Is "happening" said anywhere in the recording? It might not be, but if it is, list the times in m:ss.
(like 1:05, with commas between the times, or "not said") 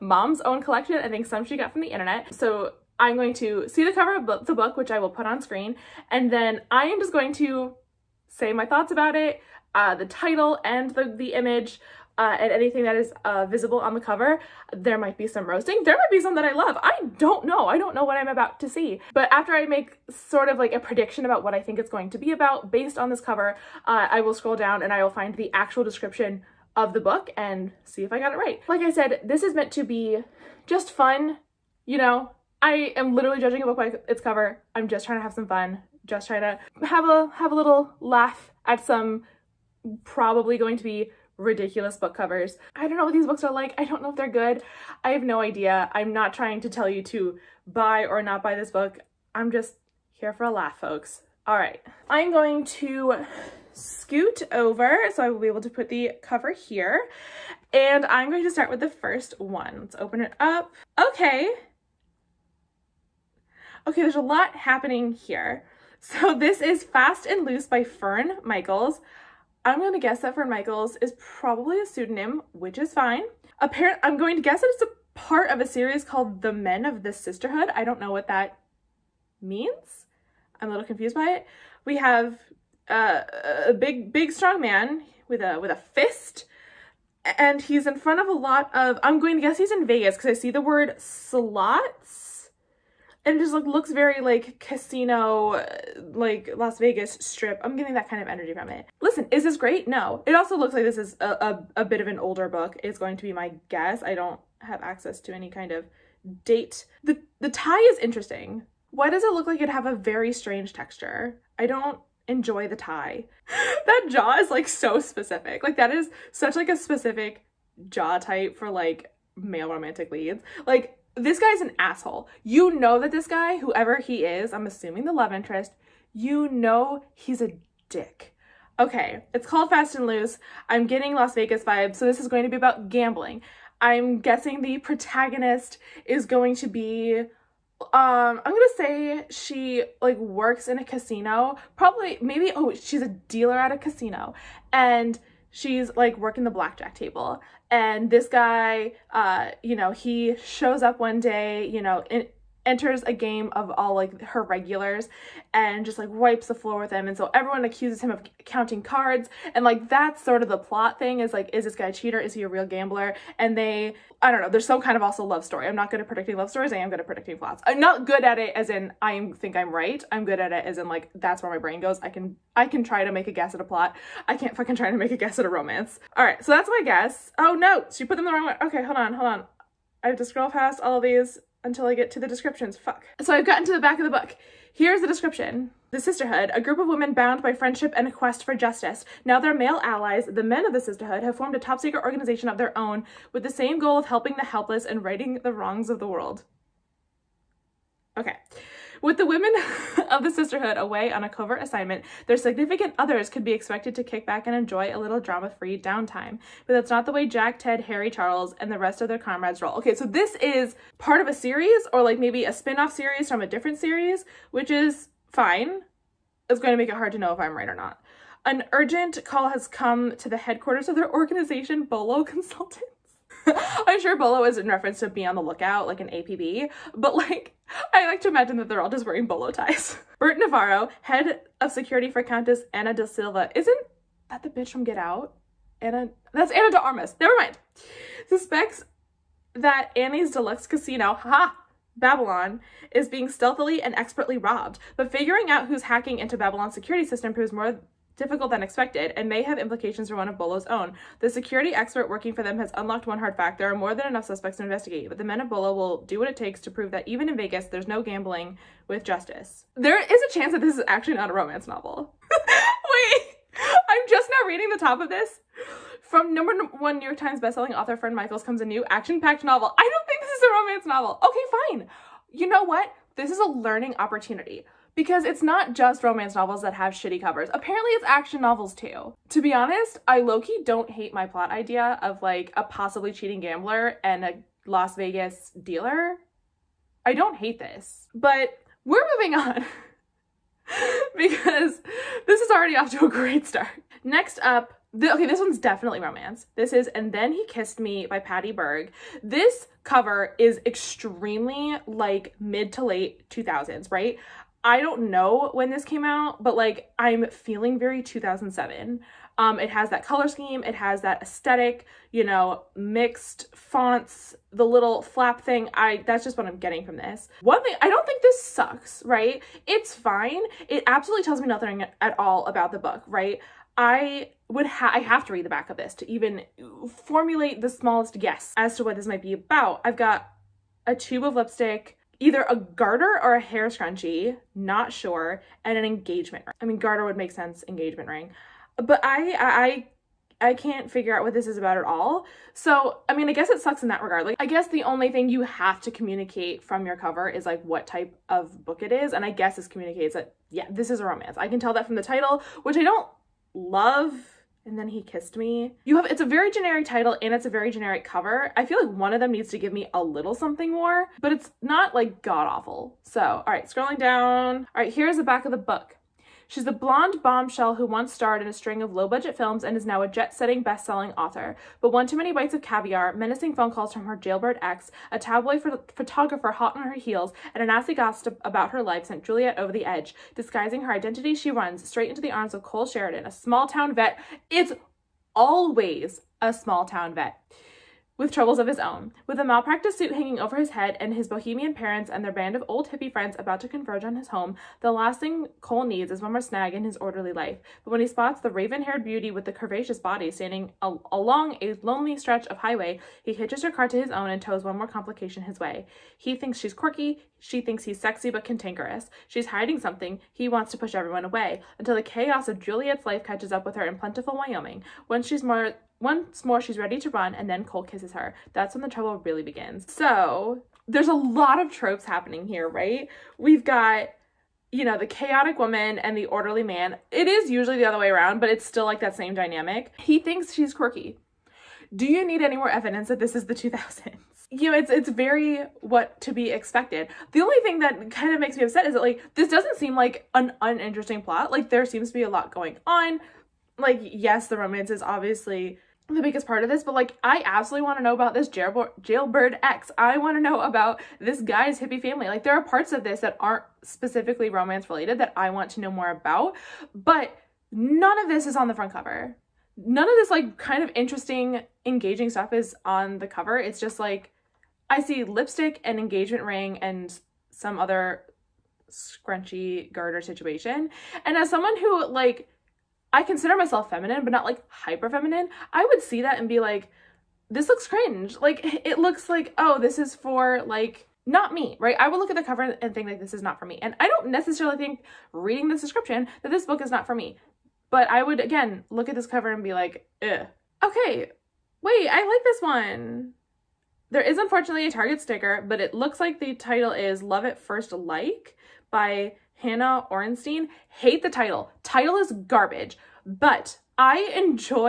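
1:04, 7:02.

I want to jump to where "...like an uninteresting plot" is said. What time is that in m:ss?
7:19.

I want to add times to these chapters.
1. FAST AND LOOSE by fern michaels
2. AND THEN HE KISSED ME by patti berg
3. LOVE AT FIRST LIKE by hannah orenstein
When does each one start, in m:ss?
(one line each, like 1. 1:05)
1. 1:00
2. 4:54
3. 8:10.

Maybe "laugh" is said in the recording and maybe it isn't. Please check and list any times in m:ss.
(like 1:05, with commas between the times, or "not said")
0:38, 0:50.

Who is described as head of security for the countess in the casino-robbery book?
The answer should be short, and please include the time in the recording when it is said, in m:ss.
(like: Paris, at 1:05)
Bert Navarro, at 3:50.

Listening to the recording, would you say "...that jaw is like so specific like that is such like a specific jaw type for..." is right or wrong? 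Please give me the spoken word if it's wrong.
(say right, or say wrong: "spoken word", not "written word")
right.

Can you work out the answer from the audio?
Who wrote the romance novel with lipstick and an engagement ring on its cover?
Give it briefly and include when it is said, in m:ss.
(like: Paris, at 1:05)
Patti Berg, at 4:58.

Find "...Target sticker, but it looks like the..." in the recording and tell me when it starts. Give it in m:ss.
8:14.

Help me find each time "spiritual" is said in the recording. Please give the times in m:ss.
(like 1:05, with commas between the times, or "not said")
not said.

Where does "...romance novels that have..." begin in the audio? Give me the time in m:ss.
4:36.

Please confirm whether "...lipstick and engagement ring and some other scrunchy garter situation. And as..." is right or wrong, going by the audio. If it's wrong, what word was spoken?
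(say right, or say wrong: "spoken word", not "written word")
right.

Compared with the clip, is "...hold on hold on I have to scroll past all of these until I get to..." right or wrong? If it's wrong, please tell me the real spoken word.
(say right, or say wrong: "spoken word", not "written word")
right.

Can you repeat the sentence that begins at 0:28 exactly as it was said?
Like I said, this is meant to be just fun, you know, I am literally judging a book by its cover.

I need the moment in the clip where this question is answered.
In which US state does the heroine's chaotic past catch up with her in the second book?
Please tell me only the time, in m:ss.
6:54.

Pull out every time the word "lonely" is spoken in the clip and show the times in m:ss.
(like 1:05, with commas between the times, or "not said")
6:41.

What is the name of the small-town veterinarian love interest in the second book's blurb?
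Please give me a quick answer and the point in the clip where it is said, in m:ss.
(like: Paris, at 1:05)
Cole Sheridan, at 6:22.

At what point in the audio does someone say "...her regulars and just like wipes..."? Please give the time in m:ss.
2:34.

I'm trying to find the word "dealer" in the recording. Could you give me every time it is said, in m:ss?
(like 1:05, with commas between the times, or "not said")
2:23, 4:45.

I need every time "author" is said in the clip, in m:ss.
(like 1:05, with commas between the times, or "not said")
4:27, 6:11.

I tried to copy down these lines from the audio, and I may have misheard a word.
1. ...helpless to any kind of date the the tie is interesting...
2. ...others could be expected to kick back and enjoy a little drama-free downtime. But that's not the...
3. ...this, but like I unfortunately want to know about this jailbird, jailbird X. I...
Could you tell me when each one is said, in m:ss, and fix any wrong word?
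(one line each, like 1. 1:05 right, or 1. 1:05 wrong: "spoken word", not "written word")
1. 1:44 wrong: "access", not "helpless"
2. 3:22 right
3. 7:26 wrong: "absolutely", not "unfortunately".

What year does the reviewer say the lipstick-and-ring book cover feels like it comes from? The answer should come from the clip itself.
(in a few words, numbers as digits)
2007.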